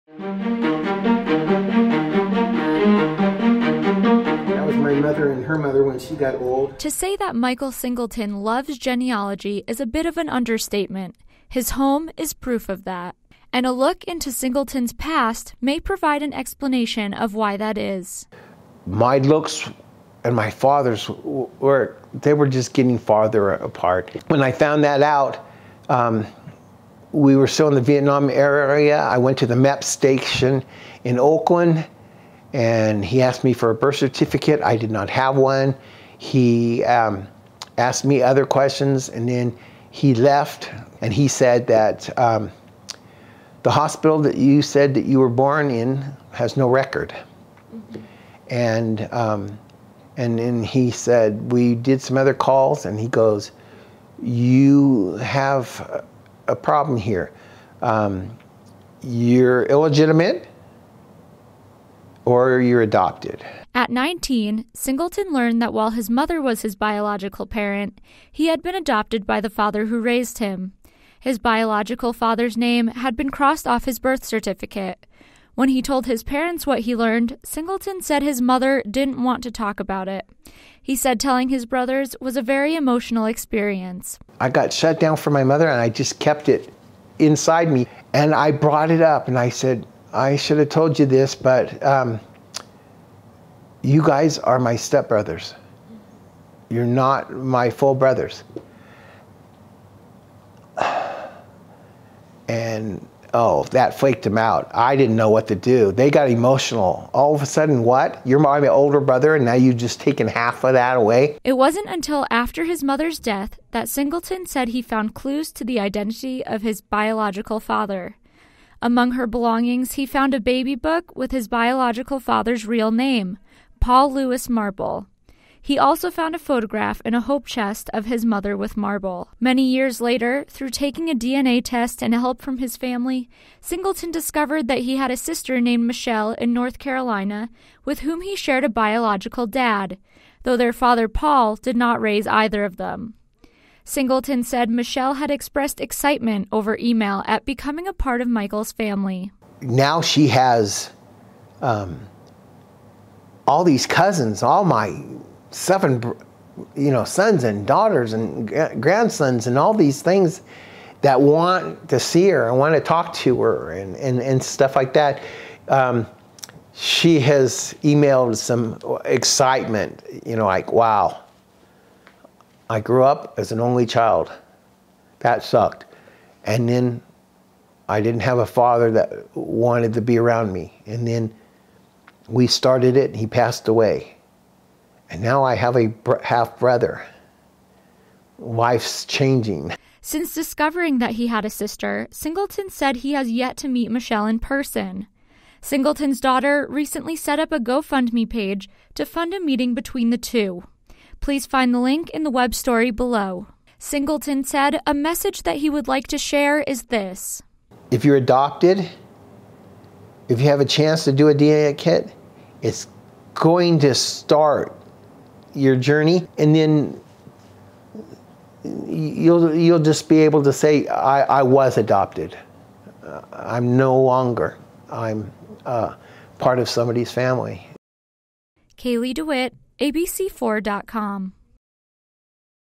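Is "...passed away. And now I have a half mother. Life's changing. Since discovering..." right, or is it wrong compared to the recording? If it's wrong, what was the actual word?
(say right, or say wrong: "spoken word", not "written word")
wrong: "brother", not "mother".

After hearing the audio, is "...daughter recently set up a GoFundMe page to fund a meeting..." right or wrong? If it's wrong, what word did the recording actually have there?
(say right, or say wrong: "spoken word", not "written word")
right.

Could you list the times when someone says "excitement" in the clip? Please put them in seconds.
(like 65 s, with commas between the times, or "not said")
145 s, 169 s.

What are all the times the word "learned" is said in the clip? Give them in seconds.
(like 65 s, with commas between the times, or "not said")
65 s, 76 s.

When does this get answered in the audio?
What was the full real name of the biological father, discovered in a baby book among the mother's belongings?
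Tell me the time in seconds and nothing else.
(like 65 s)
123 s.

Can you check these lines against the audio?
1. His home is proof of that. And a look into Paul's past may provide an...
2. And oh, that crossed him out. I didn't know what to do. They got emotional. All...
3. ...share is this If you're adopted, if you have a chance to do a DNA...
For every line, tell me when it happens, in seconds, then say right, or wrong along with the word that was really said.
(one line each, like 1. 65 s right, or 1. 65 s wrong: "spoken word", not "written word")
1. 11 s wrong: "Singleton", not "Paul"
2. 102 s wrong: "flaked", not "crossed"
3. 206 s right.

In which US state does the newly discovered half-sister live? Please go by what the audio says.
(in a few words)
North Carolina.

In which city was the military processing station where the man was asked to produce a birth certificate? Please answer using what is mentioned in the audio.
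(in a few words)
Oakland.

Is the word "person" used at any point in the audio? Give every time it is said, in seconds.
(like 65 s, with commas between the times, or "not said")
194 s.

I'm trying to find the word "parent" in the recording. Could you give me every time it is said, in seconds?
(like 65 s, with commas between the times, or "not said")
67 s, 76 s.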